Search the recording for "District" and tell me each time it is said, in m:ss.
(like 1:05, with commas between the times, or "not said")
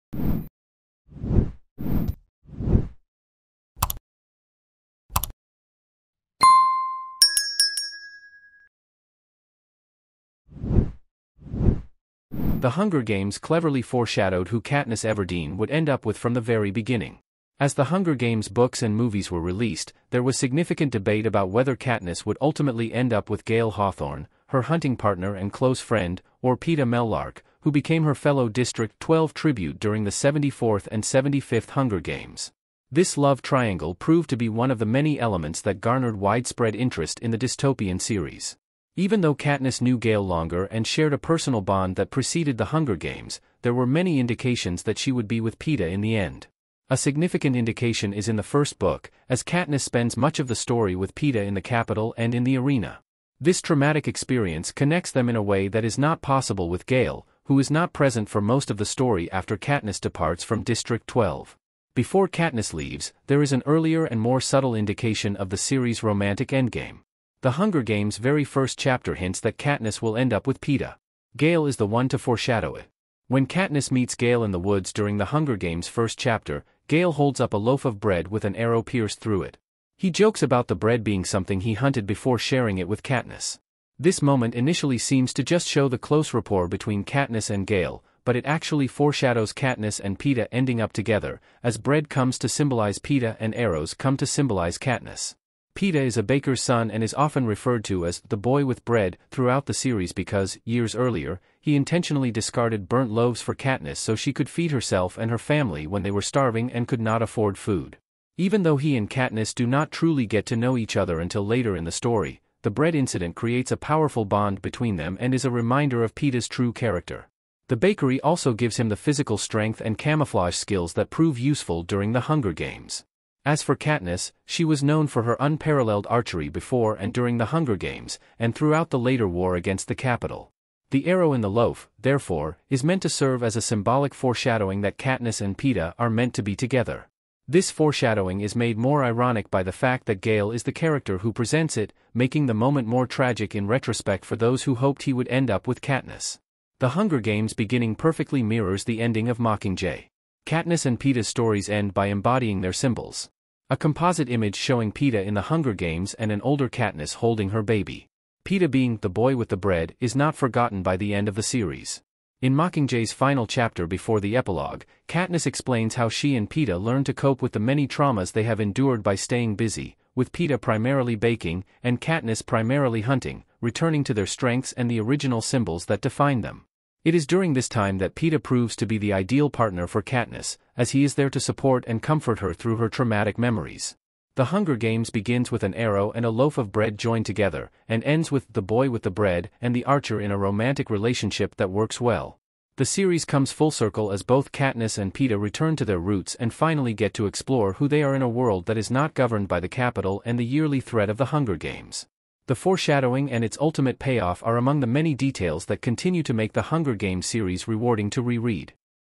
0:28, 1:00.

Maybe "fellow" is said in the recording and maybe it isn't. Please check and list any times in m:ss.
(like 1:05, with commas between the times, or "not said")
0:28.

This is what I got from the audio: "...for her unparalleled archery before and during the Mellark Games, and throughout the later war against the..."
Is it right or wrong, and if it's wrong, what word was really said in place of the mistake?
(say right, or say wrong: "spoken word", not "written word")
wrong: "Hunger", not "Mellark".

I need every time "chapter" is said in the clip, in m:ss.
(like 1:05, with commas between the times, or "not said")
1:08, 1:16, 2:43.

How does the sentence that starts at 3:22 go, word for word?
The foreshadowing and its ultimate payoff are among the many details that continue to make the Hunger Games series rewarding to reread.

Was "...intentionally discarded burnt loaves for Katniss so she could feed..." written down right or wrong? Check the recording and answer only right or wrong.
right.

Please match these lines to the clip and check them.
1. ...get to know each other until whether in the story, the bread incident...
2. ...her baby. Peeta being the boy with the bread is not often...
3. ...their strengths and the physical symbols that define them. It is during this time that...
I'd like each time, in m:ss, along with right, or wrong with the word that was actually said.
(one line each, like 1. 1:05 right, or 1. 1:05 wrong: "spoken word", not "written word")
1. 1:50 wrong: "later", not "whether"
2. 2:37 wrong: "forgotten", not "often"
3. 2:54 wrong: "original", not "physical".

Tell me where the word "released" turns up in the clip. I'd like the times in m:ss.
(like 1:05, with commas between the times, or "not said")
0:19.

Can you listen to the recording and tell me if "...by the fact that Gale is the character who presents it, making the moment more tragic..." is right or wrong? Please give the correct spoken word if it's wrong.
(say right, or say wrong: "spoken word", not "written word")
right.